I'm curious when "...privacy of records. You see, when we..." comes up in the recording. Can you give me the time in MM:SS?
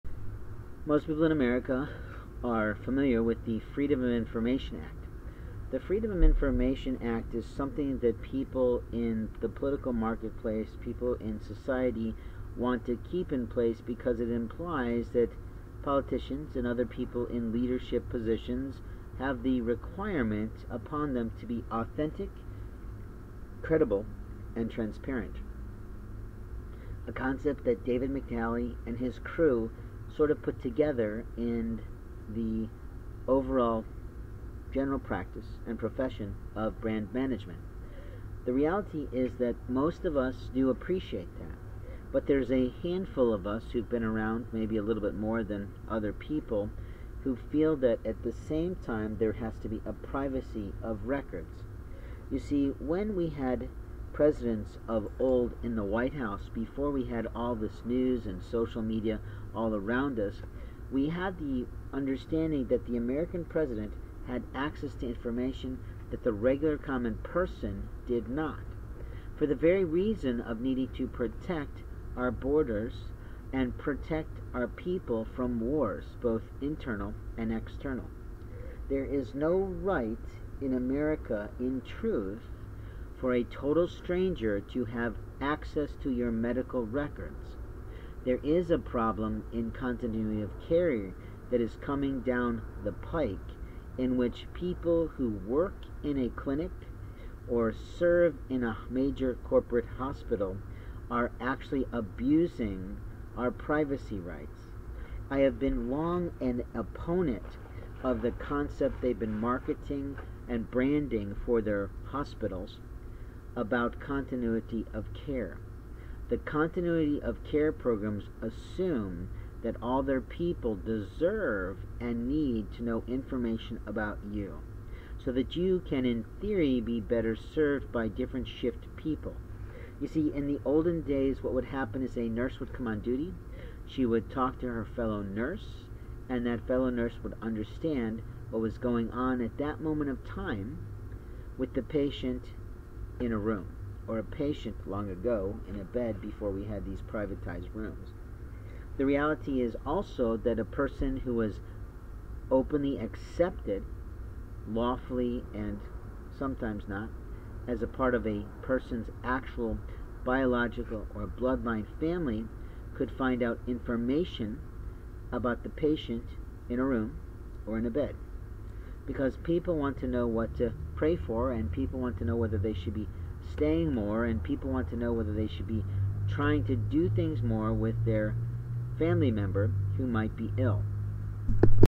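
00:49.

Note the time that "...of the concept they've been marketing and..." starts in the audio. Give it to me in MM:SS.
01:48.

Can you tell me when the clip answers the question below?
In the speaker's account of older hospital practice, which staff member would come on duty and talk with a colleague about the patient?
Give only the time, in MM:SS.
02:12.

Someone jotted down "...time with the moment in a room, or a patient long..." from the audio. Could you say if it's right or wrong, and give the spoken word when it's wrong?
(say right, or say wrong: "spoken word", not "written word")
wrong: "patient", not "moment".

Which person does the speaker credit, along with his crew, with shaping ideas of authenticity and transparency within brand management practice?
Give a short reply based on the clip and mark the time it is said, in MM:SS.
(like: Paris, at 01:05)
David McNally, at 00:27.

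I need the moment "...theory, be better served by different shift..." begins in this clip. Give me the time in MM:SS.
02:06.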